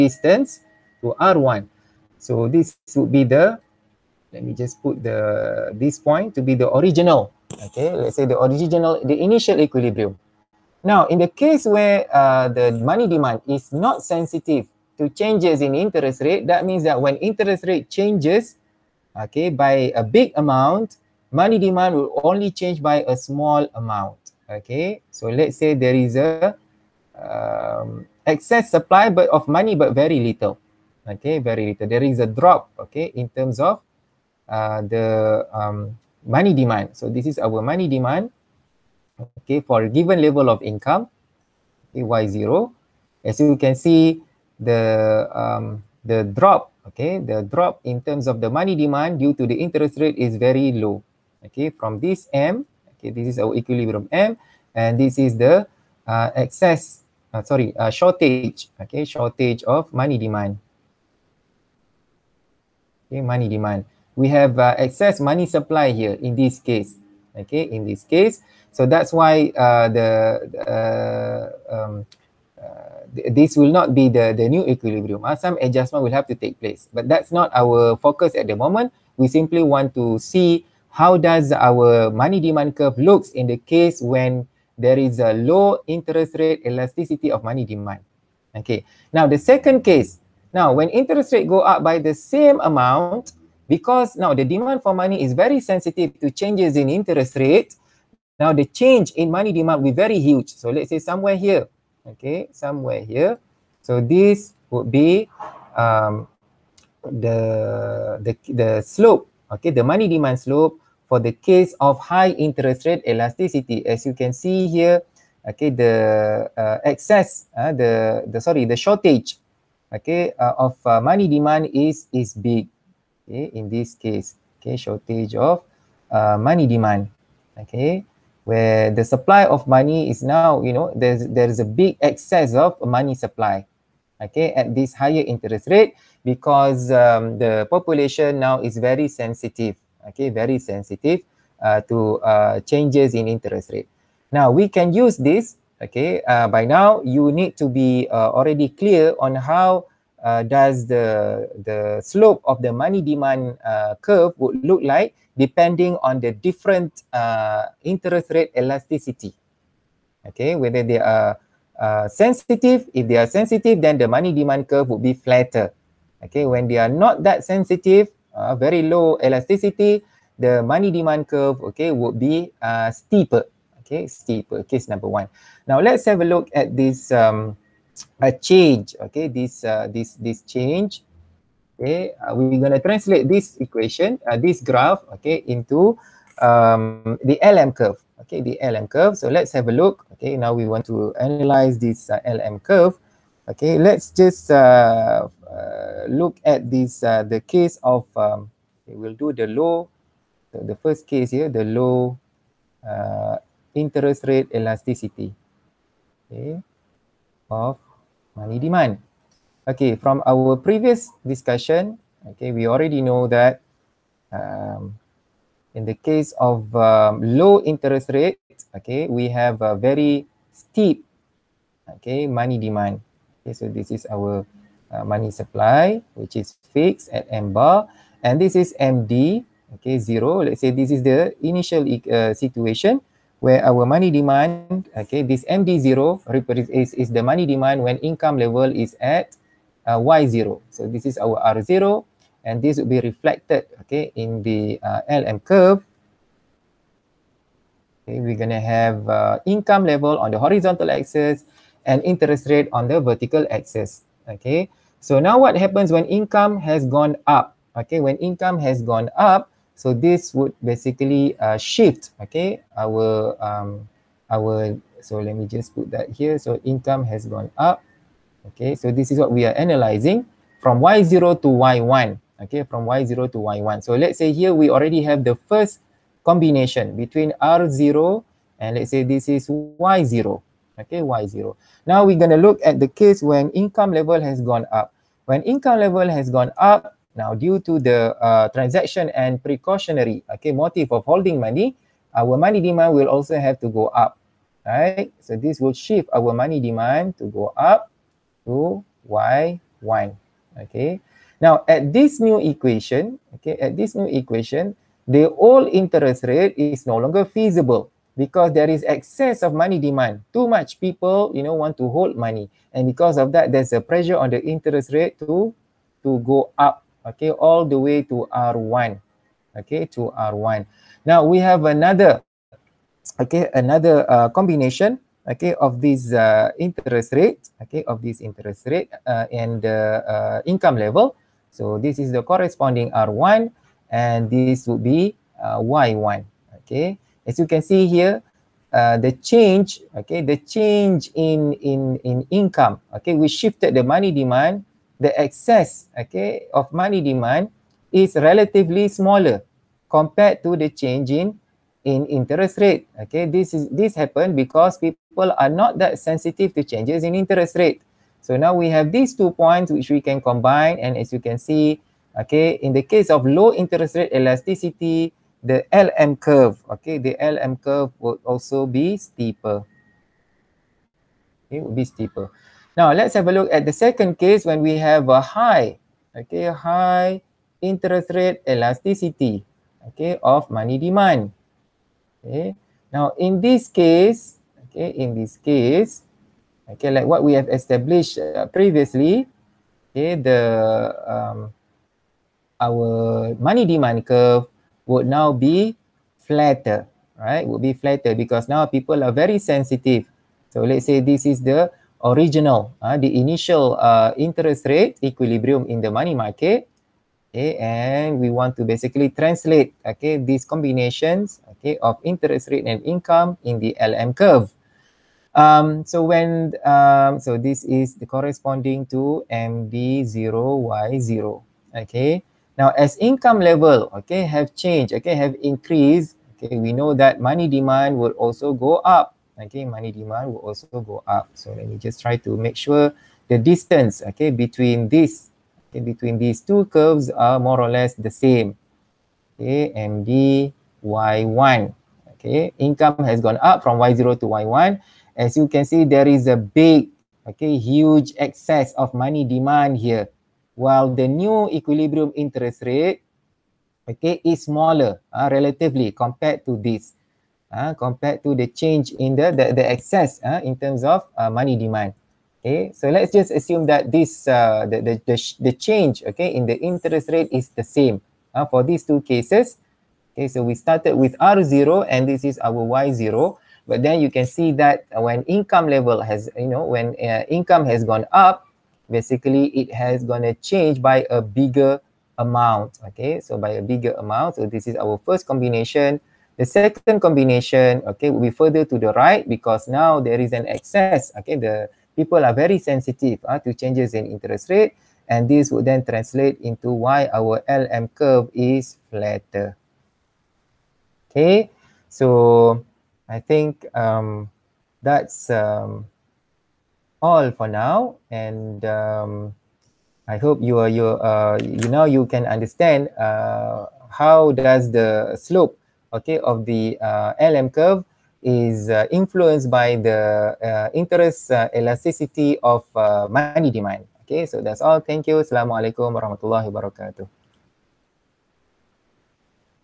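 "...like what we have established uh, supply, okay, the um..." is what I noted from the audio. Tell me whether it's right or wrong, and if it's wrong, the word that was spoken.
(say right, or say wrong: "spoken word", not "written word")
wrong: "previously", not "supply".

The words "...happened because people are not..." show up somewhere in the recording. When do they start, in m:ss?
5:53.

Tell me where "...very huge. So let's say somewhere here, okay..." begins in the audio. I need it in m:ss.
1:39.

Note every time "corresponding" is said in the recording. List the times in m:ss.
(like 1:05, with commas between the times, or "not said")
5:32, 6:58.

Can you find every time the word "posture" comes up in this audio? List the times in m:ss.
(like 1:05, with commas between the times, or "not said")
not said.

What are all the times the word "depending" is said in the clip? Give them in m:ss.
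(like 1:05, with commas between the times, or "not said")
2:35.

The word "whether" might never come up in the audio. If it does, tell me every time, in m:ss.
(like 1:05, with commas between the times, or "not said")
2:40.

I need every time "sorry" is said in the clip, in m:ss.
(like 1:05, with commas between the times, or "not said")
0:57, 1:58.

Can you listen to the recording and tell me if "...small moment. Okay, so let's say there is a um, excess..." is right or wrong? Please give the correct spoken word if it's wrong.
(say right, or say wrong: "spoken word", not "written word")
wrong: "amount", not "moment".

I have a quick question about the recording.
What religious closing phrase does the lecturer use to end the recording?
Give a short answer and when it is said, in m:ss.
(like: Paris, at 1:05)
Assalamualaikum warahmatullahi wabarakatuh, at 8:45.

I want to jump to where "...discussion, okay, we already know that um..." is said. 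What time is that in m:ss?
3:31.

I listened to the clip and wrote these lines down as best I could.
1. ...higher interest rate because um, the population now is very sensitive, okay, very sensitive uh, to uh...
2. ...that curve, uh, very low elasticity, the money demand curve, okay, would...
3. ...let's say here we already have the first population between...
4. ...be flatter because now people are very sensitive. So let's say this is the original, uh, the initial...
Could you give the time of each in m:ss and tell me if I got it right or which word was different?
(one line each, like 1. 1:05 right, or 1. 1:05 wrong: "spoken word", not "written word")
1. 2:14 right
2. 2:47 wrong: "sensitive", not "curve"
3. 4:33 wrong: "combination", not "population"
4. 6:37 right.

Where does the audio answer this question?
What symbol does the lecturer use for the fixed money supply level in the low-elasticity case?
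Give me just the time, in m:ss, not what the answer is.
3:47.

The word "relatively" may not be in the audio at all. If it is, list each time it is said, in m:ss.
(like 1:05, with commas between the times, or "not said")
5:48, 7:35.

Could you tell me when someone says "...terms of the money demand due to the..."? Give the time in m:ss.
0:48.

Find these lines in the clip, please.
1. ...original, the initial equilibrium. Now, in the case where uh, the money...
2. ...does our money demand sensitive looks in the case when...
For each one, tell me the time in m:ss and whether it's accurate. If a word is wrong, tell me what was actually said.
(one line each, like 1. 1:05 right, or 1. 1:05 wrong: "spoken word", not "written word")
1. 0:08 right
2. 1:21 wrong: "curve", not "sensitive".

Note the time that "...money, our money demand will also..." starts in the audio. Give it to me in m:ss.
4:51.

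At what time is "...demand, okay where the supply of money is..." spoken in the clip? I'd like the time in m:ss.
2:06.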